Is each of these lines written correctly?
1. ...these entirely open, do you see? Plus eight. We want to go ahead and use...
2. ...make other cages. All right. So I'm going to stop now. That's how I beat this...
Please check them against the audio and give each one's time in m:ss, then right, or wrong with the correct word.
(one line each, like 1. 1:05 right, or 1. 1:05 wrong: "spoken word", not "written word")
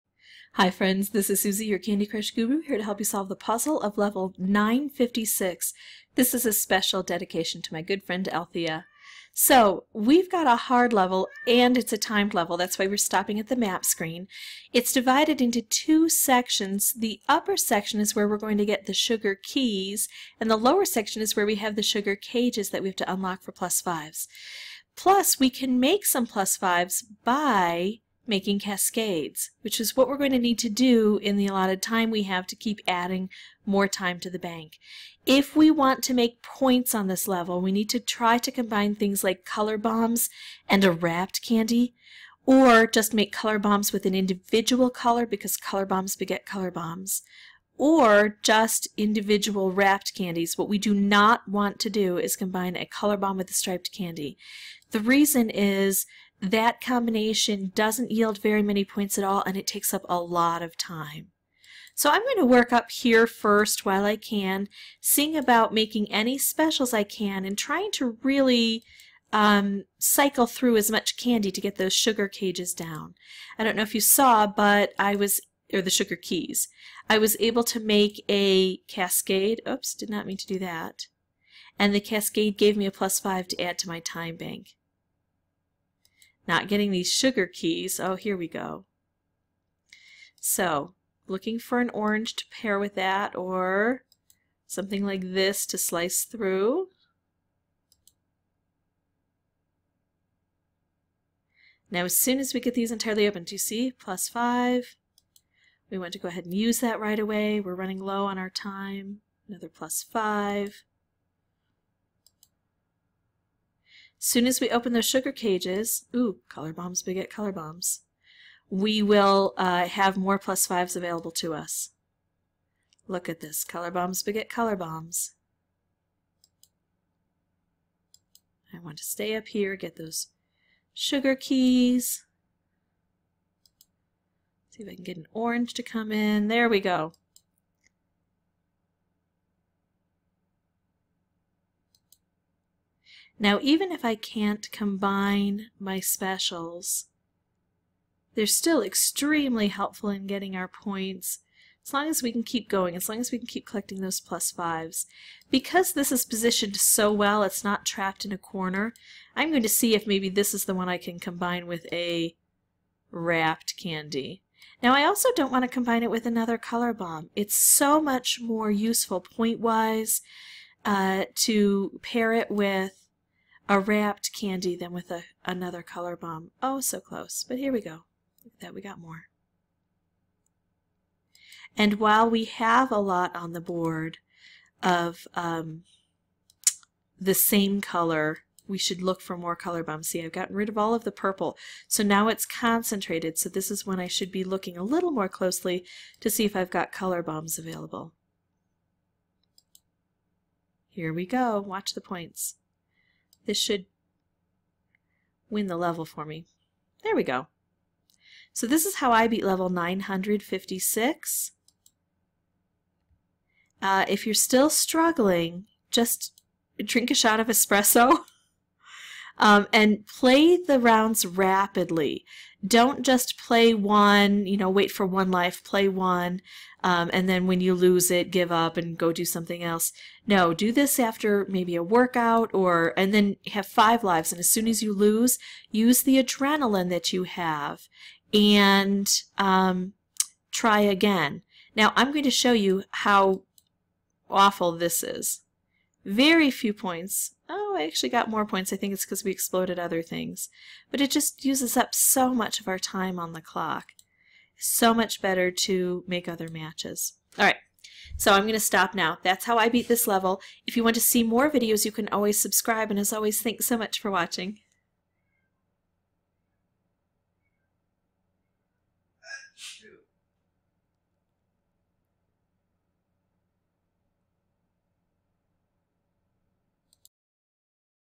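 1. 1:42 wrong: "five", not "eight"
2. 4:16 wrong: "matches", not "cages".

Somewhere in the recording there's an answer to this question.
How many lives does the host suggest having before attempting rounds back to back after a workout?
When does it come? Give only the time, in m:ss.
3:53.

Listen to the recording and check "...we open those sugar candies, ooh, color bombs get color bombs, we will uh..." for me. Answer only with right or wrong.
wrong.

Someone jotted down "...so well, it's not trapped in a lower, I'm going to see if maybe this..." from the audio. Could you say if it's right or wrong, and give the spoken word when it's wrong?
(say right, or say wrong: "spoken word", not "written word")
wrong: "corner", not "lower".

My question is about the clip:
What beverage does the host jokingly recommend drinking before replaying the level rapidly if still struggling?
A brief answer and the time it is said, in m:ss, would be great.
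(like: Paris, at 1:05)
espresso, at 3:37.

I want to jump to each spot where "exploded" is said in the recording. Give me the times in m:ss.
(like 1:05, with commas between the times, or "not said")
4:09.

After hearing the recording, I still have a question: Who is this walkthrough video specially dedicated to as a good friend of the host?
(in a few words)
Althea.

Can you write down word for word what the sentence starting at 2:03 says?
Look at this, color bombs get color bombs.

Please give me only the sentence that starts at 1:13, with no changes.
I don't know if you saw, but I was, or the sugar keys, I was able to make a cascade.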